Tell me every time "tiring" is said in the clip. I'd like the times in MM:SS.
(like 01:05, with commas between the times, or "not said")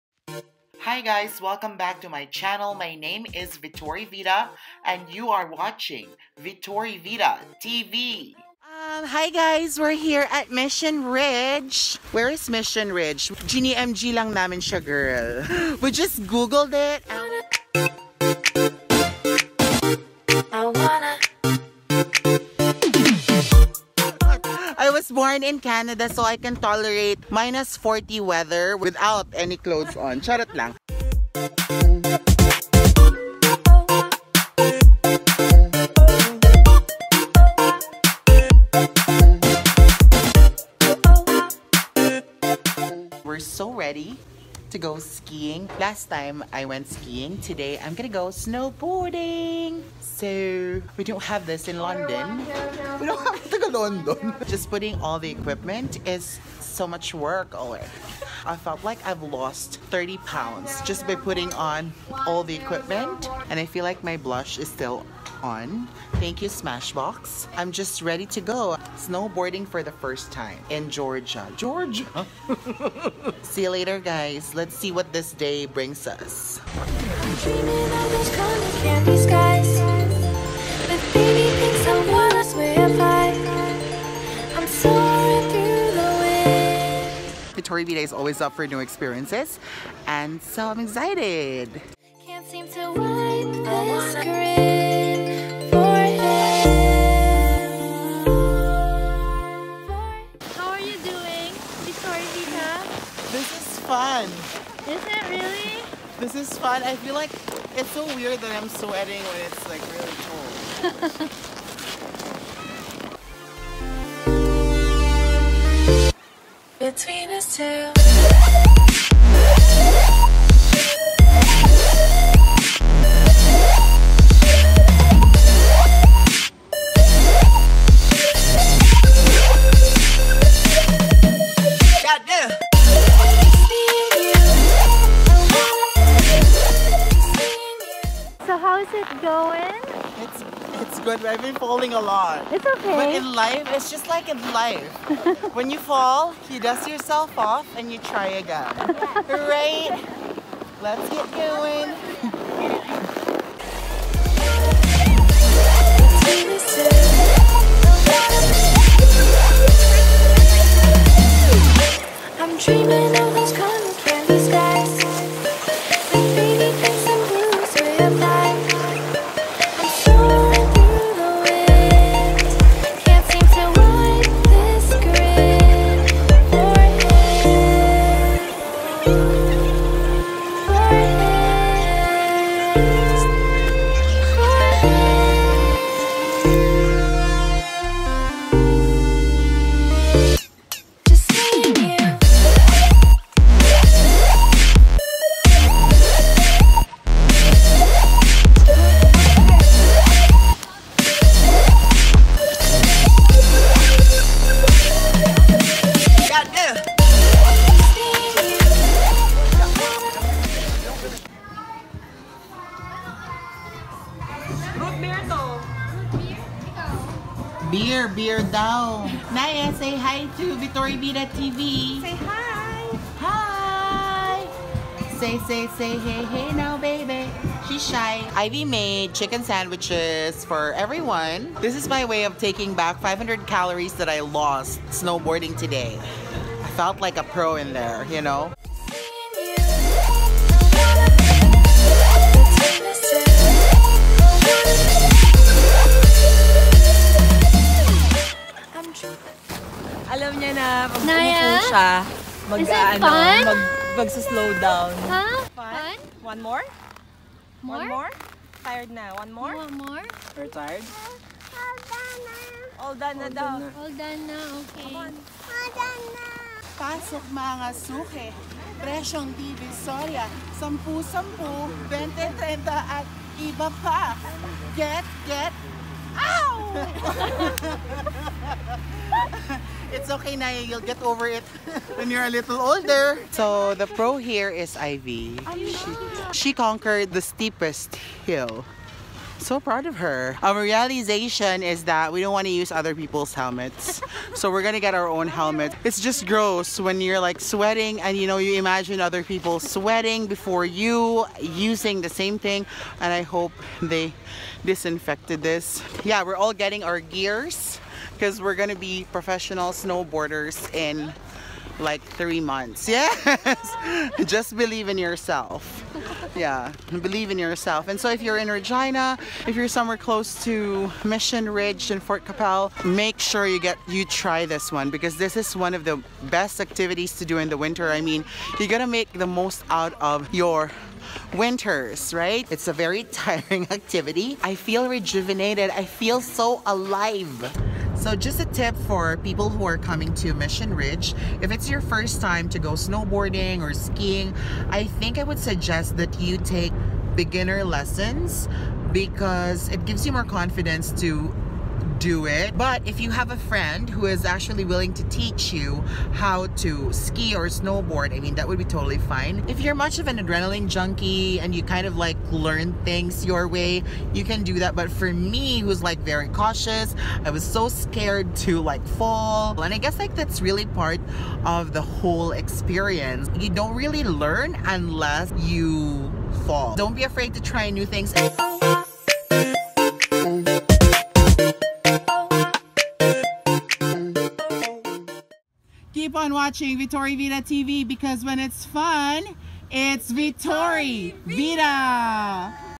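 05:33.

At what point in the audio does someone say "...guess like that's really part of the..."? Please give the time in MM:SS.
06:09.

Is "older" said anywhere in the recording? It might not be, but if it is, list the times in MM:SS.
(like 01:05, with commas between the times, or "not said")
04:42.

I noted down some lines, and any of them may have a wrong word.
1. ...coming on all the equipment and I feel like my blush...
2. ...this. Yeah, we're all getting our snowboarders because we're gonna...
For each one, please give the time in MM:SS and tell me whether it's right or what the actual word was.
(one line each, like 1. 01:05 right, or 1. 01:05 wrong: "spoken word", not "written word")
1. 01:01 wrong: "putting", not "coming"
2. 05:05 wrong: "gears", not "snowboarders".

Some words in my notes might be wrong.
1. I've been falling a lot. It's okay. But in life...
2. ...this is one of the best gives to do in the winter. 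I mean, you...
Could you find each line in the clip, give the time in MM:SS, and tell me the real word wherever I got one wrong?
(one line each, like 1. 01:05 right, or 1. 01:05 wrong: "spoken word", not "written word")
1. 02:21 right
2. 05:25 wrong: "activities", not "gives".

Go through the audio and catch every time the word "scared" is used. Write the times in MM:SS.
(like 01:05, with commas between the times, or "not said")
06:07.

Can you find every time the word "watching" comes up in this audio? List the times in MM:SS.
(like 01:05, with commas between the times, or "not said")
00:05, 06:26.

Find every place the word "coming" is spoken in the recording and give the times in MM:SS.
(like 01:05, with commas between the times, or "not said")
05:39.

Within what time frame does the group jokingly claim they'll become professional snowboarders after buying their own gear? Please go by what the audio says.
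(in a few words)
3 months.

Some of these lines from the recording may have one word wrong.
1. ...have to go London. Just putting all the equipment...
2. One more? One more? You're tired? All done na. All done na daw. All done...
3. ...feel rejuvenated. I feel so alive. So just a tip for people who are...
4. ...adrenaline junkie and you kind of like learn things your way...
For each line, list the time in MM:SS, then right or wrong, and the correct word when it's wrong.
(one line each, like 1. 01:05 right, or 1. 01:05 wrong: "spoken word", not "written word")
1. 00:53 right
2. 04:19 right
3. 05:34 right
4. 06:00 right.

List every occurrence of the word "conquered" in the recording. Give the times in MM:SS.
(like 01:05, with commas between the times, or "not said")
04:46.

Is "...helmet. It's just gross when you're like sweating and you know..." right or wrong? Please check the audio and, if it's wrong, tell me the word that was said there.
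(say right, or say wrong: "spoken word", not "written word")
right.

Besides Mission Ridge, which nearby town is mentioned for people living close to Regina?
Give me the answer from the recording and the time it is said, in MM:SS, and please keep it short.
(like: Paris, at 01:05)
Fort Qu'Appelle, at 05:22.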